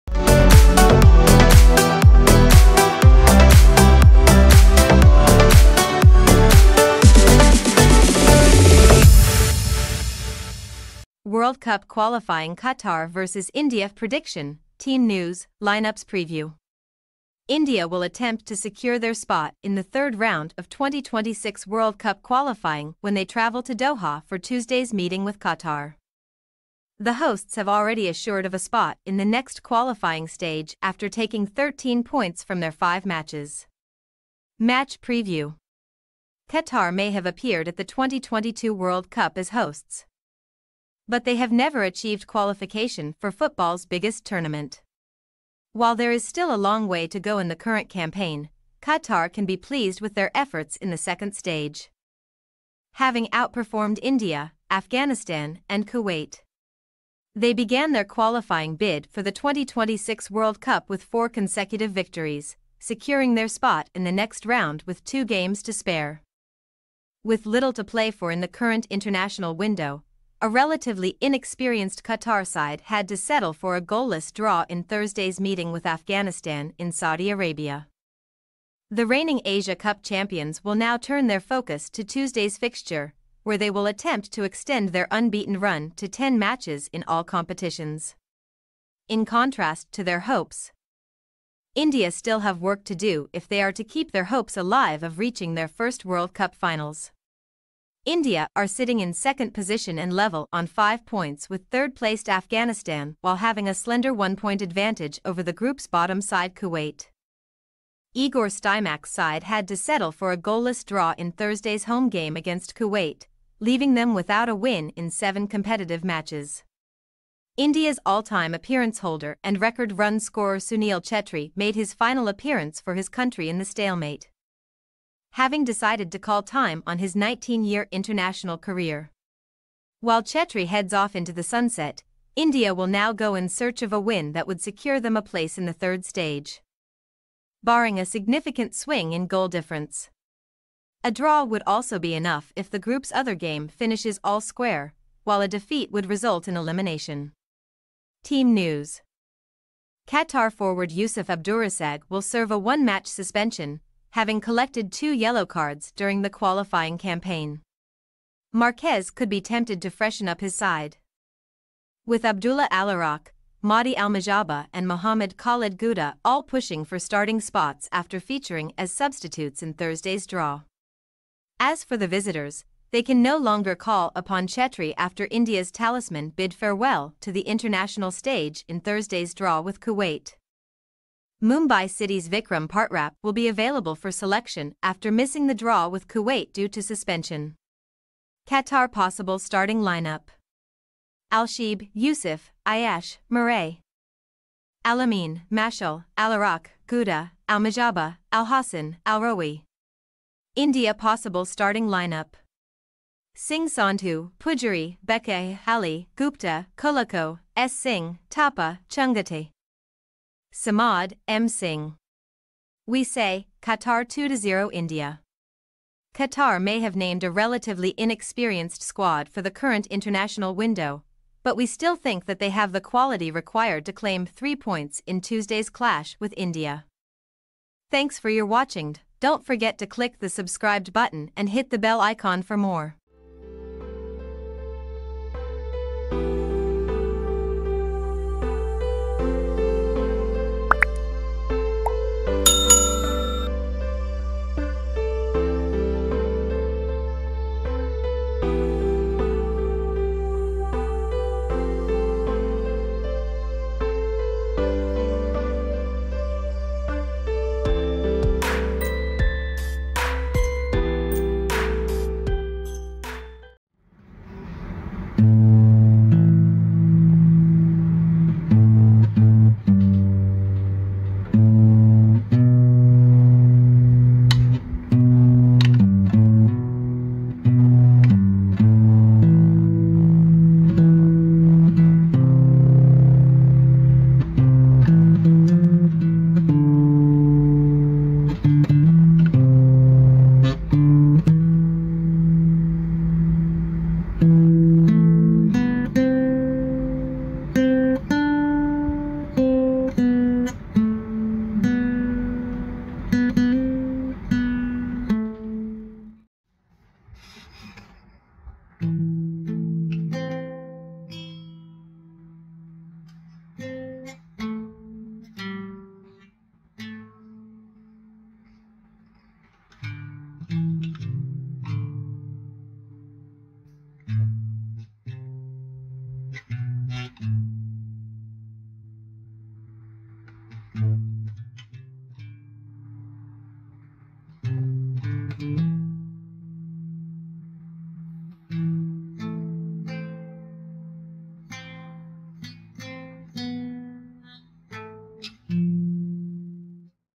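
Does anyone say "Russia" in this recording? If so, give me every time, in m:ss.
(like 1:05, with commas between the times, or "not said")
not said.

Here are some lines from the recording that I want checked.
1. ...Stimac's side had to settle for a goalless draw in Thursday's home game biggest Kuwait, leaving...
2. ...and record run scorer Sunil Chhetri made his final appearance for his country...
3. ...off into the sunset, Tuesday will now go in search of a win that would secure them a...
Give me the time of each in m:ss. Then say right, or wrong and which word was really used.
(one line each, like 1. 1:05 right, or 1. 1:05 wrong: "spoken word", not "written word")
1. 1:48 wrong: "against", not "biggest"
2. 1:59 right
3. 2:10 wrong: "India", not "Tuesday".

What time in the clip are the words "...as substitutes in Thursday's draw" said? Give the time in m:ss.
2:48.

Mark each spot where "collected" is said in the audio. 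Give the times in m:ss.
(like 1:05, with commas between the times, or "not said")
2:34.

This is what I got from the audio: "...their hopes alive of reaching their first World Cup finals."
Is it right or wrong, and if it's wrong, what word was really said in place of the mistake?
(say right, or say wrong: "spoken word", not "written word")
right.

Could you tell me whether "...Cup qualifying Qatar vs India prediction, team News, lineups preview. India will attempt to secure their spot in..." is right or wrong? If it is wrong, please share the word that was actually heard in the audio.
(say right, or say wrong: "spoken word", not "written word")
right.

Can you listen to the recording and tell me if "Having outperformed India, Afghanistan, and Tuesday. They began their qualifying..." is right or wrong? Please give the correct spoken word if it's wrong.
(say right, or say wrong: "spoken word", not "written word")
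wrong: "Kuwait", not "Tuesday".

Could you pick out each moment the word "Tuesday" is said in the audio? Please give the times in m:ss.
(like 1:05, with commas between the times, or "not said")
0:24, 1:22, 3:45.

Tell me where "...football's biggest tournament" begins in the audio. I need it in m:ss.
0:43.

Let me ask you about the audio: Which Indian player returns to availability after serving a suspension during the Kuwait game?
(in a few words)
Vikram Partap.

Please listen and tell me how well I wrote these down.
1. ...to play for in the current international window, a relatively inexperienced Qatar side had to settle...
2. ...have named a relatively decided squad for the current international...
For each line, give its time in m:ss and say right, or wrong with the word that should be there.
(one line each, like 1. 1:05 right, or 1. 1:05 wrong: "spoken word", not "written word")
1. 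1:07 right
2. 3:36 wrong: "inexperienced", not "decided".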